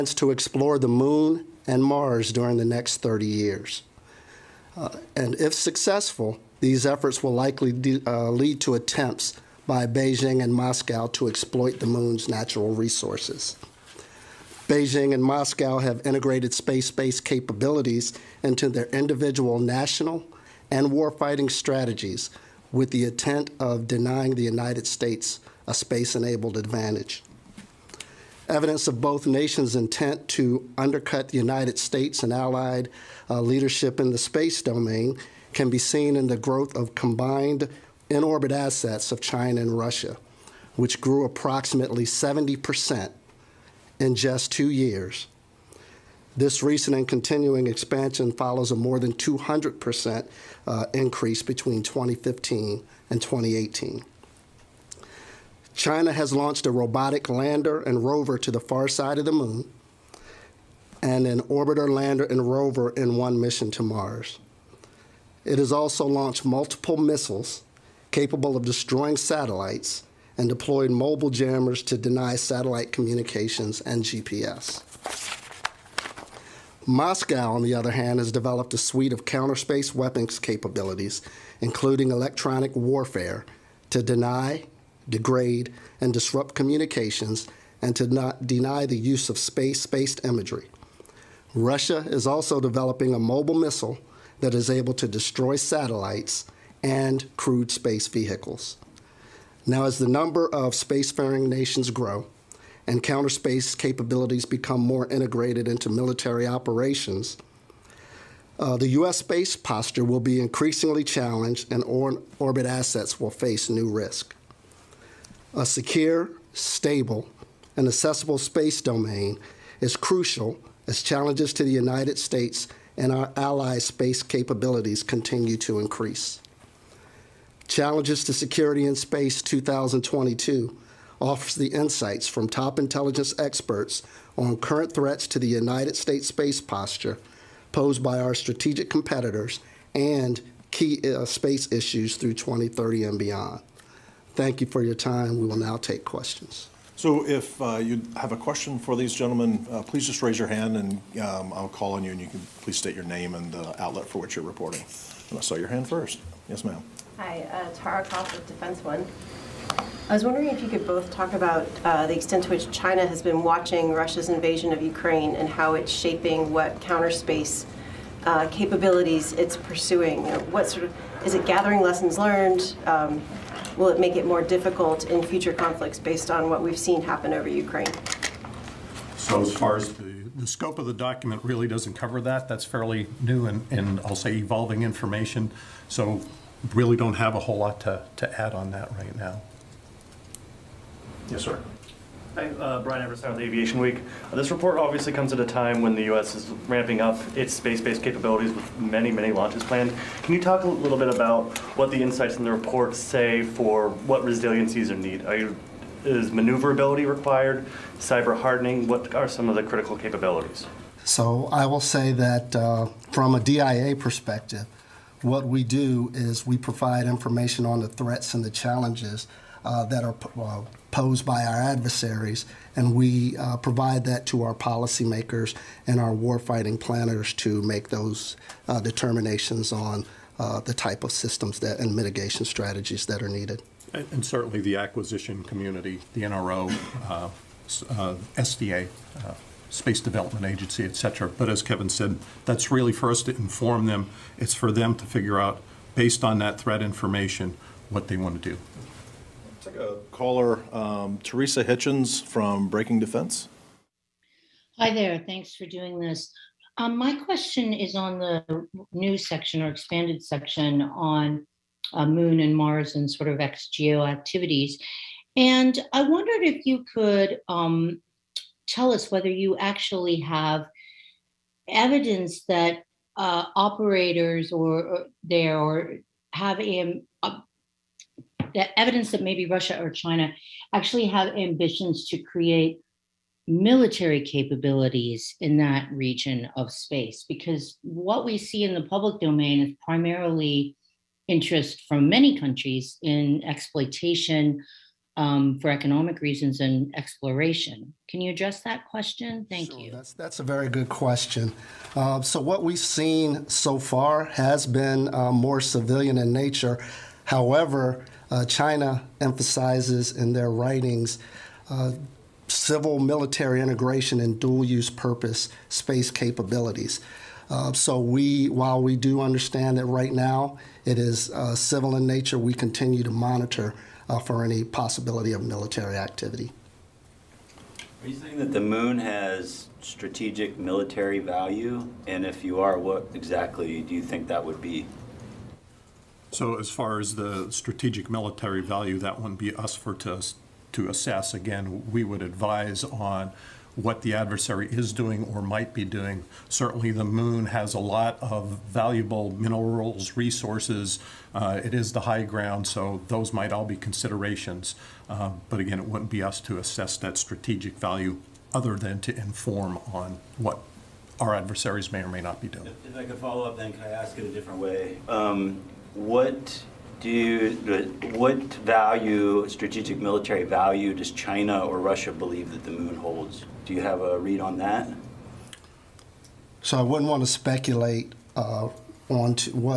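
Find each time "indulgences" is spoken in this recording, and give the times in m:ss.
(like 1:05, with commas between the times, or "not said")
not said.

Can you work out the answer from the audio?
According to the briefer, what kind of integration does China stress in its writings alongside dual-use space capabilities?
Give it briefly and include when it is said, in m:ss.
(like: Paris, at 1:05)
civil military integration, at 5:12.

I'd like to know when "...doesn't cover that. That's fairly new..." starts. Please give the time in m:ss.
3:01.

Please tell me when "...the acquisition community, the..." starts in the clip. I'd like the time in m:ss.
3:54.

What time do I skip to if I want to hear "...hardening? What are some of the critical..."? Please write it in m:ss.
3:28.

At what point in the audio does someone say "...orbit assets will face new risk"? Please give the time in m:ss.
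1:52.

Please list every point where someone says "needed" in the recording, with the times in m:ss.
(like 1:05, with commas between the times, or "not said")
3:24, 3:53.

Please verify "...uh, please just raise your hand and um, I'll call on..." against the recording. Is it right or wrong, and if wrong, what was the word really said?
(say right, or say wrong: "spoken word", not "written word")
right.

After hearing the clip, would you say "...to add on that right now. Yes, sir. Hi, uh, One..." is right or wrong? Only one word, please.
wrong.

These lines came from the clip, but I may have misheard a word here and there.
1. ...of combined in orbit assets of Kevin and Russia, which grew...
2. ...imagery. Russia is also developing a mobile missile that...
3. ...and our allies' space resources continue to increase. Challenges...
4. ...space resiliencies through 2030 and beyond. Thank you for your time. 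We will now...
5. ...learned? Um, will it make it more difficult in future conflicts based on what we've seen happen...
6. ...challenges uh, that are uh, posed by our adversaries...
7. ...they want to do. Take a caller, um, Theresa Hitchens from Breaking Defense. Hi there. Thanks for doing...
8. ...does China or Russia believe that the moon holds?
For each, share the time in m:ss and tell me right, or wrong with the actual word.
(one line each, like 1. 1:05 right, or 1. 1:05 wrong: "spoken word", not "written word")
1. 0:36 wrong: "China", not "Kevin"
2. 1:30 right
3. 2:02 wrong: "capabilities", not "resources"
4. 2:21 wrong: "issues", not "resiliencies"
5. 2:52 right
6. 3:38 right
7. 4:08 right
8. 6:10 right.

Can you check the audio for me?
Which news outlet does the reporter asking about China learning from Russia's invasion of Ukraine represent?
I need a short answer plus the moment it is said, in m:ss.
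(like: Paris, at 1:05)
Defense One, at 2:38.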